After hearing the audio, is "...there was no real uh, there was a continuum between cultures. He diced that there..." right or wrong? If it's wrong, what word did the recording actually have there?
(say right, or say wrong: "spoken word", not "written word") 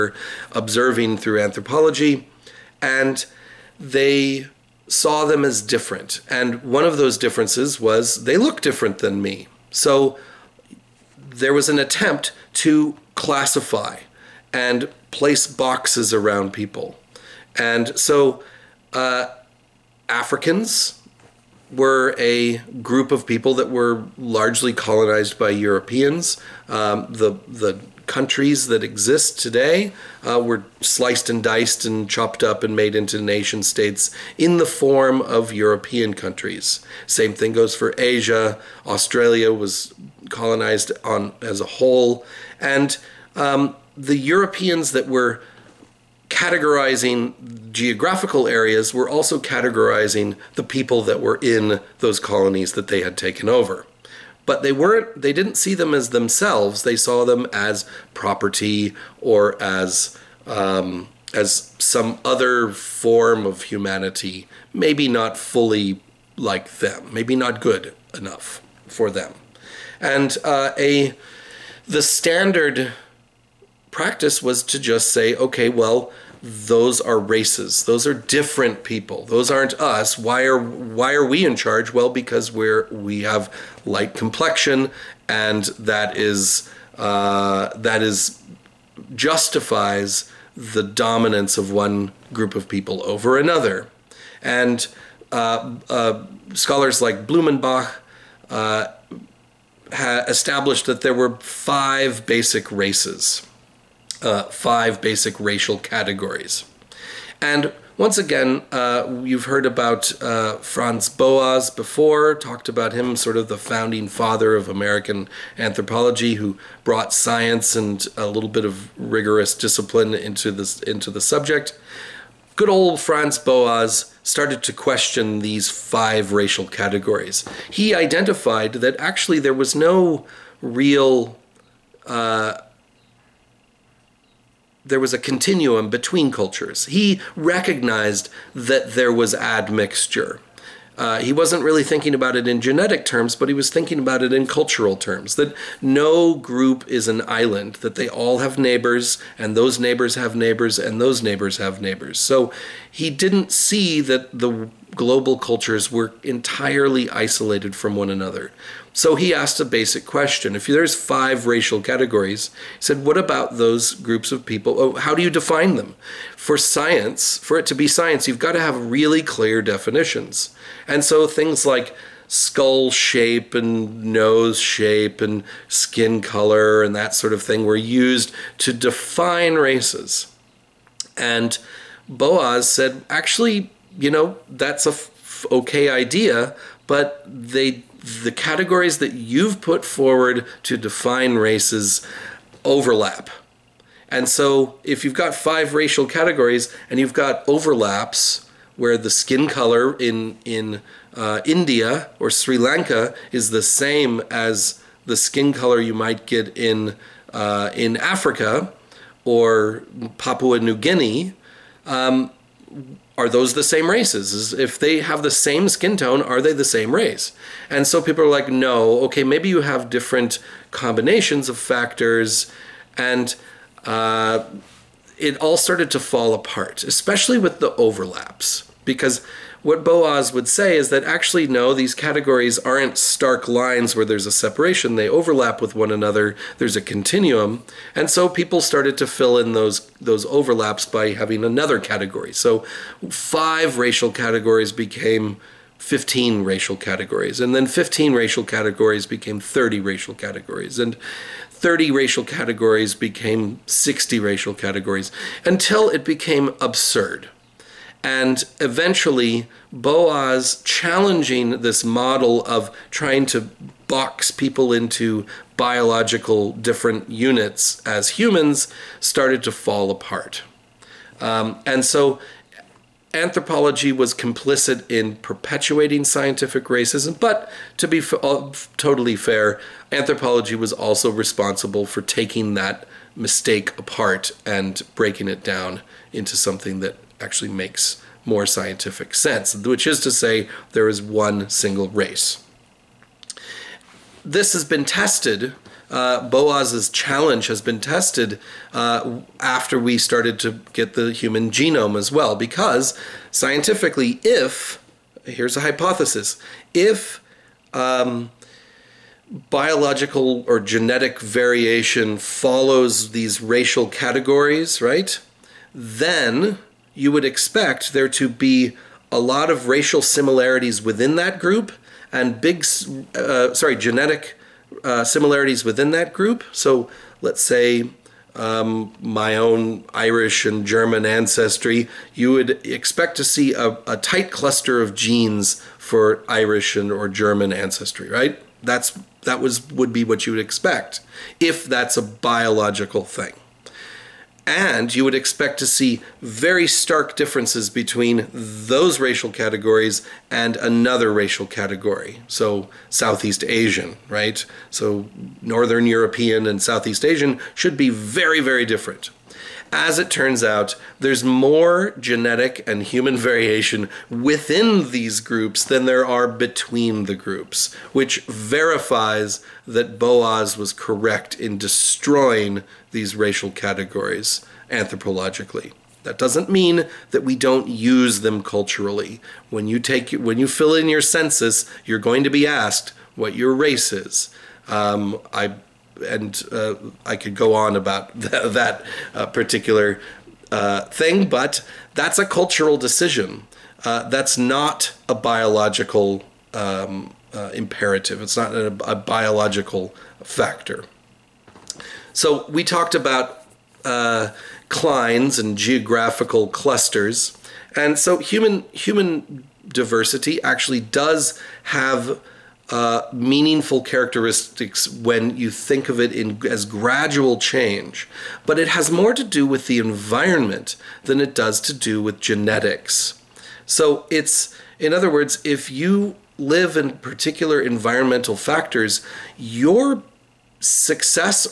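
wrong: "recognized", not "diced".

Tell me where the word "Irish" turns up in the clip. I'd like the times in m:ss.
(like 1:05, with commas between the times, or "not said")
5:29, 5:36.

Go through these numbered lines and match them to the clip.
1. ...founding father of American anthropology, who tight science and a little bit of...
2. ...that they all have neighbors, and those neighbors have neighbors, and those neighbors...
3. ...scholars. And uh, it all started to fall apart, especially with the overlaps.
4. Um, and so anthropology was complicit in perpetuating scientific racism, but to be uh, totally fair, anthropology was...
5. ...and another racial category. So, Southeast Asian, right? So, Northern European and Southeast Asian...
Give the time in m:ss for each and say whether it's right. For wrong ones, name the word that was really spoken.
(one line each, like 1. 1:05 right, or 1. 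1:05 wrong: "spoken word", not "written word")
1. 1:53 wrong: "brought", not "tight"
2. 2:27 right
3. 3:41 wrong: "factors", not "scholars"
4. 4:31 right
5. 5:50 right.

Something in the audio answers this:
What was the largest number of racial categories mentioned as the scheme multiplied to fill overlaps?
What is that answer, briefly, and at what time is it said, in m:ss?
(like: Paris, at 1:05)
60, at 4:13.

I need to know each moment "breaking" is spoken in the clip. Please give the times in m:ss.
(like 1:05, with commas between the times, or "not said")
4:44.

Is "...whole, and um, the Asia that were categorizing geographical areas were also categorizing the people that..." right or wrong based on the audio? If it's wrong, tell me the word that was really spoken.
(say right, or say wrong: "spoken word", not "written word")
wrong: "Europeans", not "Asia".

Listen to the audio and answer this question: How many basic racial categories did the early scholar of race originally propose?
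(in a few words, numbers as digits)
5.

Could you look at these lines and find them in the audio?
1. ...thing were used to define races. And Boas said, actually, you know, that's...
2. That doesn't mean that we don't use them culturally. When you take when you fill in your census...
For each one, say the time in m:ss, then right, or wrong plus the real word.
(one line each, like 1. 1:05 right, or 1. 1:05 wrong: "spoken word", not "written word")
1. 2:57 right
2. 6:16 right.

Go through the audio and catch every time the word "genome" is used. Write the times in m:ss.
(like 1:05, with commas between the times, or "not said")
5:01.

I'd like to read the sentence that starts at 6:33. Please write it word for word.
Uh, that's not a biological um, uh, imperative.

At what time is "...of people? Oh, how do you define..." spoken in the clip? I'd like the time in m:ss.
2:44.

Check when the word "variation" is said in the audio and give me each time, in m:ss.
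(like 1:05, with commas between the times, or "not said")
5:11, 6:03.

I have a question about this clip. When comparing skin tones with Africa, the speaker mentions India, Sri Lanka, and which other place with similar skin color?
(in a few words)
Papua New Guinea.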